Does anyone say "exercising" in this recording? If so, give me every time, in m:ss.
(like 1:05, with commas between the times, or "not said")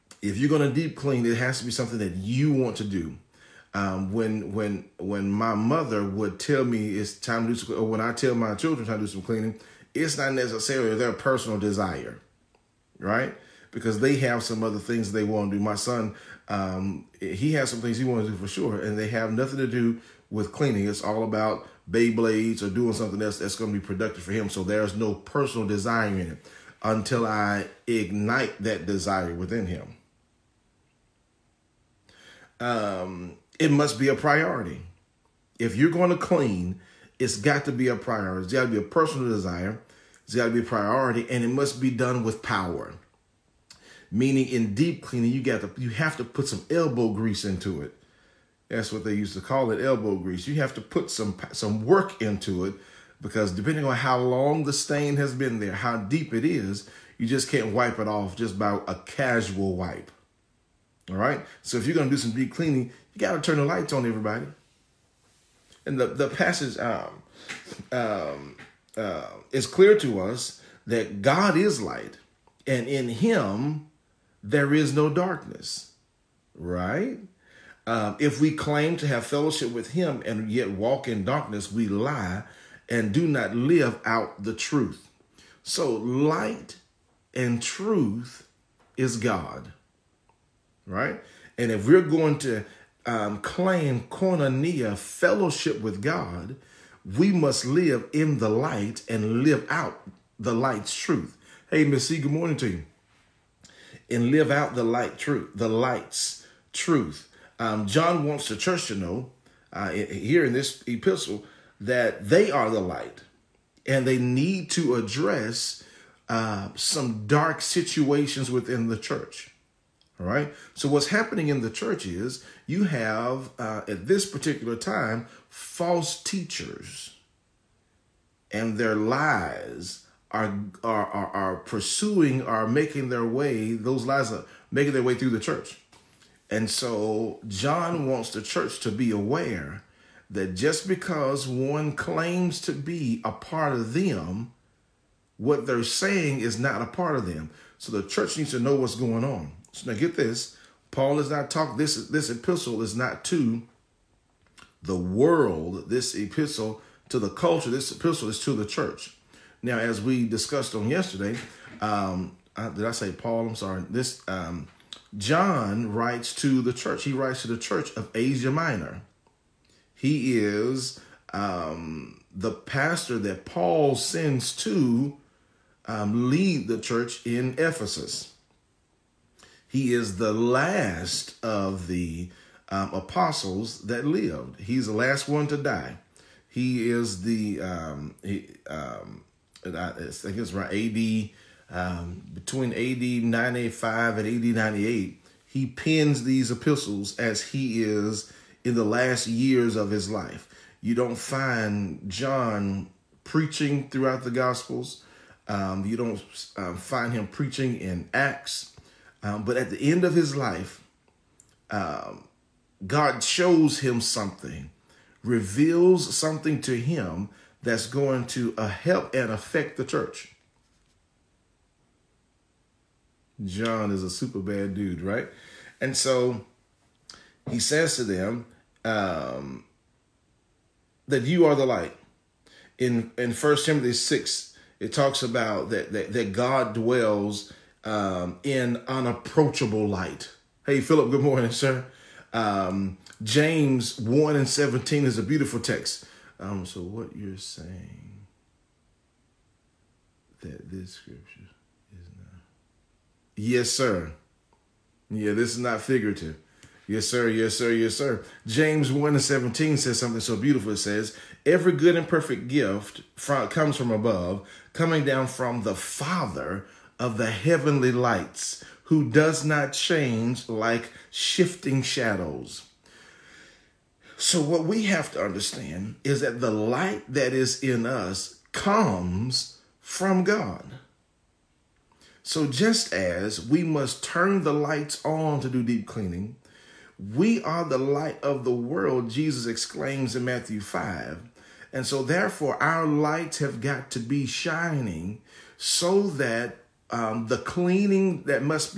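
not said.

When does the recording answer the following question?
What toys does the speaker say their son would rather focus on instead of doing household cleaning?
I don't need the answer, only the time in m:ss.
0:21.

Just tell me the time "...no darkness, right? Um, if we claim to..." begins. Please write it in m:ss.
1:14.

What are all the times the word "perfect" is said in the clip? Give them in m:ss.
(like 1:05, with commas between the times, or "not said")
4:22.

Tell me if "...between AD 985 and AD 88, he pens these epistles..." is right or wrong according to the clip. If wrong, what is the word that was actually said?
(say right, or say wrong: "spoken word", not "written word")
wrong: "98", not "88".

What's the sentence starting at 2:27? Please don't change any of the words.
So the church needs to know what's going on.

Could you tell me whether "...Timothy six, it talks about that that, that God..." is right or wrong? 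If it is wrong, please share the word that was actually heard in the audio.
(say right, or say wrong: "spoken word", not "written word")
right.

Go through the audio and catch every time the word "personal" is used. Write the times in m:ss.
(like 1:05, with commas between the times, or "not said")
0:11, 0:25, 0:38.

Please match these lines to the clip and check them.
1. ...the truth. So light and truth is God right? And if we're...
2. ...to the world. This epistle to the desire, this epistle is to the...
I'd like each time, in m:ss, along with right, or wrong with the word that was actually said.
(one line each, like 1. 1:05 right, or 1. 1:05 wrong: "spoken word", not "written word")
1. 1:24 right
2. 2:33 wrong: "culture", not "desire".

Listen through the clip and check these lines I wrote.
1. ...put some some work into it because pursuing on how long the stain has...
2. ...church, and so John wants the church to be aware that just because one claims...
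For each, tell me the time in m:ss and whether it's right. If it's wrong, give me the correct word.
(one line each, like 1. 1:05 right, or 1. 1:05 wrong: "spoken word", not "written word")
1. 0:50 wrong: "depending", not "pursuing"
2. 2:15 right.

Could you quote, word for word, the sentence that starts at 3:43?
John is a super bad dude, right?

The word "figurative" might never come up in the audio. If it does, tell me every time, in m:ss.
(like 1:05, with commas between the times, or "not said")
4:15.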